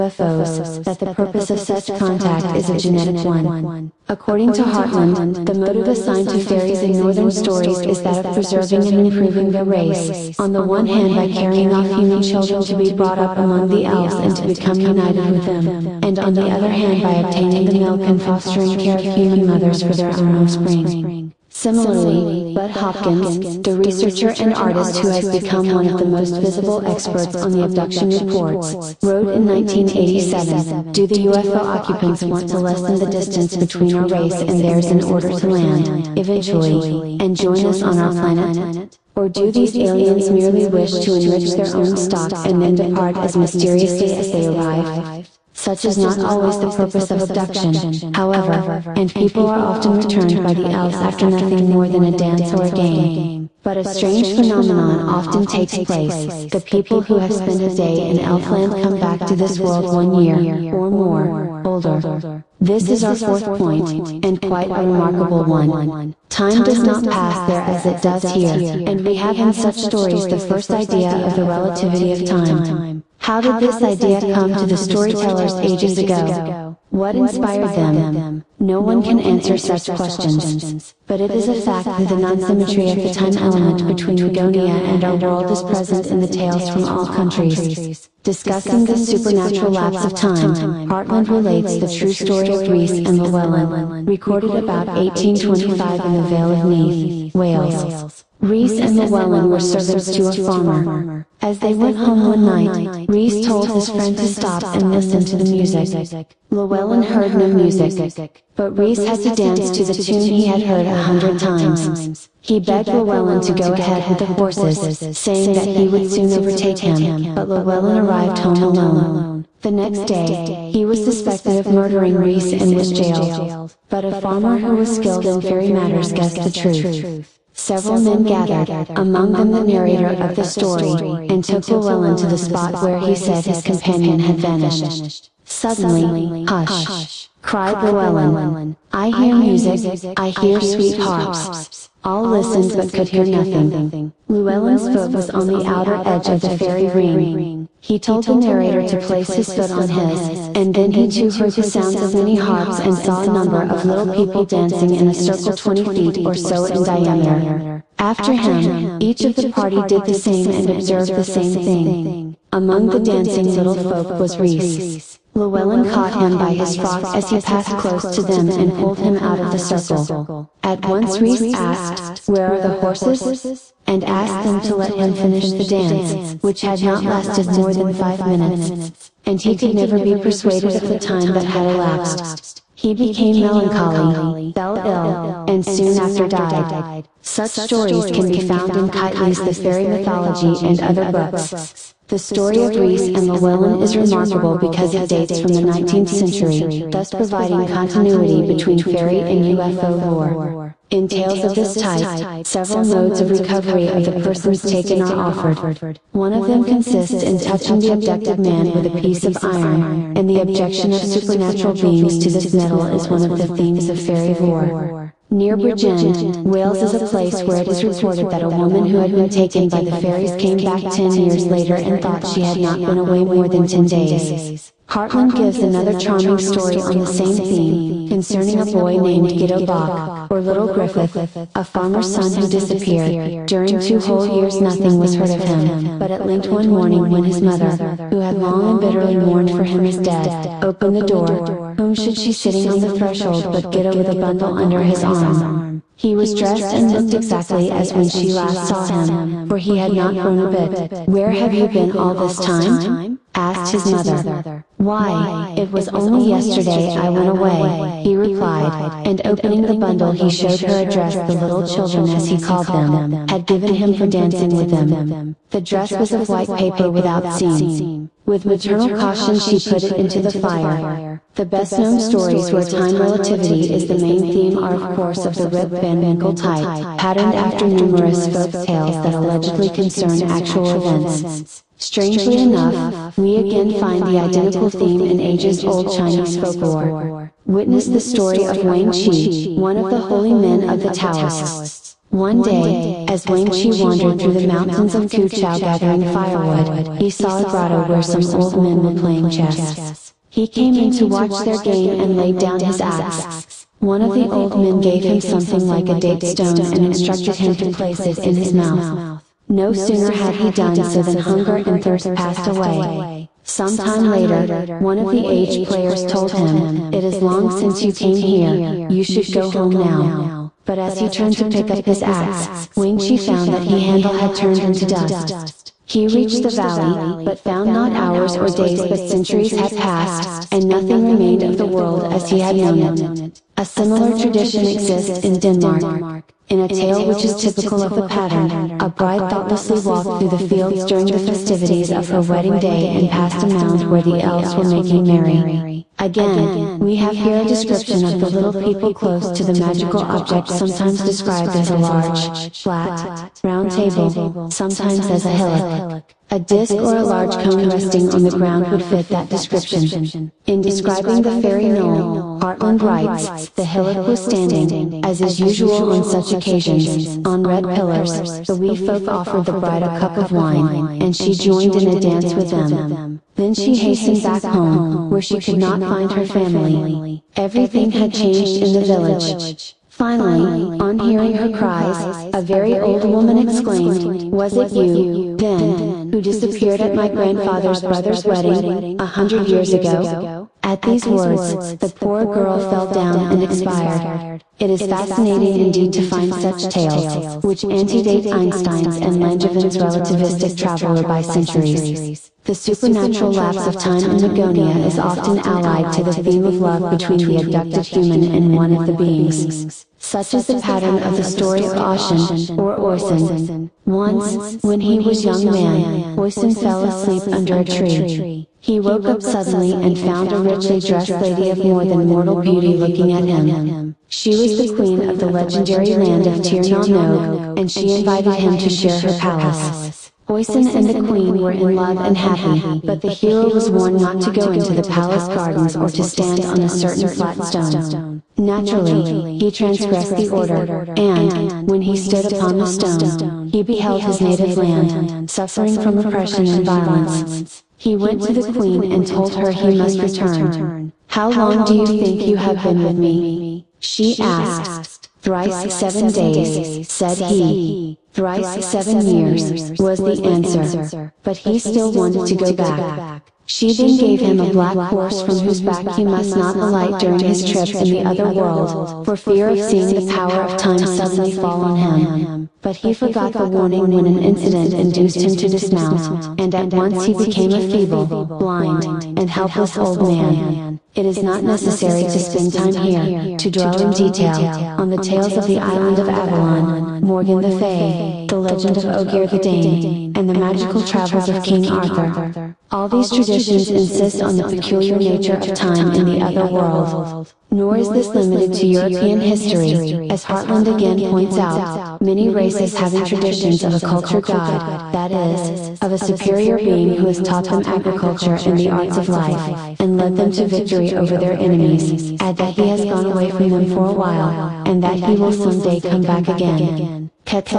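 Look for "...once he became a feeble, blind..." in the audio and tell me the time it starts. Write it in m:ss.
7:56.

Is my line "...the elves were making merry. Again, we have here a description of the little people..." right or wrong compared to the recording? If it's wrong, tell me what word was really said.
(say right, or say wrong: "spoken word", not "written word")
right.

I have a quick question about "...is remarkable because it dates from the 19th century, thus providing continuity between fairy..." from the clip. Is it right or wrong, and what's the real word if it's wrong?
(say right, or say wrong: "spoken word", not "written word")
right.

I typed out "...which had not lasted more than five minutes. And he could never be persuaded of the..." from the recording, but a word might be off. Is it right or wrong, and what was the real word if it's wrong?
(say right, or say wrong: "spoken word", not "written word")
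right.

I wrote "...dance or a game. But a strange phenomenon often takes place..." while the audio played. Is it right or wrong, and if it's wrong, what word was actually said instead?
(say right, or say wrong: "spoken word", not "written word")
right.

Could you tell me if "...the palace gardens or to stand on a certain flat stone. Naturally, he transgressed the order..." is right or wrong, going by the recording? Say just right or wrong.
right.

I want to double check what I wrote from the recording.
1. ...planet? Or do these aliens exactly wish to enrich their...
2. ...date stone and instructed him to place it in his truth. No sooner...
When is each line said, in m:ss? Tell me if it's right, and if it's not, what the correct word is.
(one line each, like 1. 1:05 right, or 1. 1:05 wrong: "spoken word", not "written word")
1. 0:38 wrong: "merely", not "exactly"
2. 5:05 wrong: "mouth", not "truth".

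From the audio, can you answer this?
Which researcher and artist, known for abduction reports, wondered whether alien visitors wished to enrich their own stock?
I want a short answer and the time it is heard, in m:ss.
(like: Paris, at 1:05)
Bud Hopkins, at 0:22.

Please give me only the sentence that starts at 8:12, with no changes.
All these traditions insist on the peculiar nature of time in the other world.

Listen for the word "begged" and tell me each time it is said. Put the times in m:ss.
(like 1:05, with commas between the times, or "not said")
1:52.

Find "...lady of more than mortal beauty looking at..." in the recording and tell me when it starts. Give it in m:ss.
7:01.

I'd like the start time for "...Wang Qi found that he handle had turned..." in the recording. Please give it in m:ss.
5:22.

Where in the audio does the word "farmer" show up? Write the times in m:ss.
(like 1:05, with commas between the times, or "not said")
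1:40, 2:04, 3:51.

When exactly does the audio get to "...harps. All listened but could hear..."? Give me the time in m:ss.
2:20.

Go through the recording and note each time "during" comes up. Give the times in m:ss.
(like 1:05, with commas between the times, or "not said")
3:53, 5:40, 7:46.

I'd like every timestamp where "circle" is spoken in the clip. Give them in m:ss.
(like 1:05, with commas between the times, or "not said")
2:35, 2:49.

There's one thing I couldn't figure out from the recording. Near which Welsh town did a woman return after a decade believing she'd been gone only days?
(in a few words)
Bridgend.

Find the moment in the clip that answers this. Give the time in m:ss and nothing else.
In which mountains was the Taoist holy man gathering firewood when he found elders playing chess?
4:55.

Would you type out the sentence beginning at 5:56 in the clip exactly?
A disc or a large cone resting on the ground would fit that description.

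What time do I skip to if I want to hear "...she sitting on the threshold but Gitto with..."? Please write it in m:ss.
4:02.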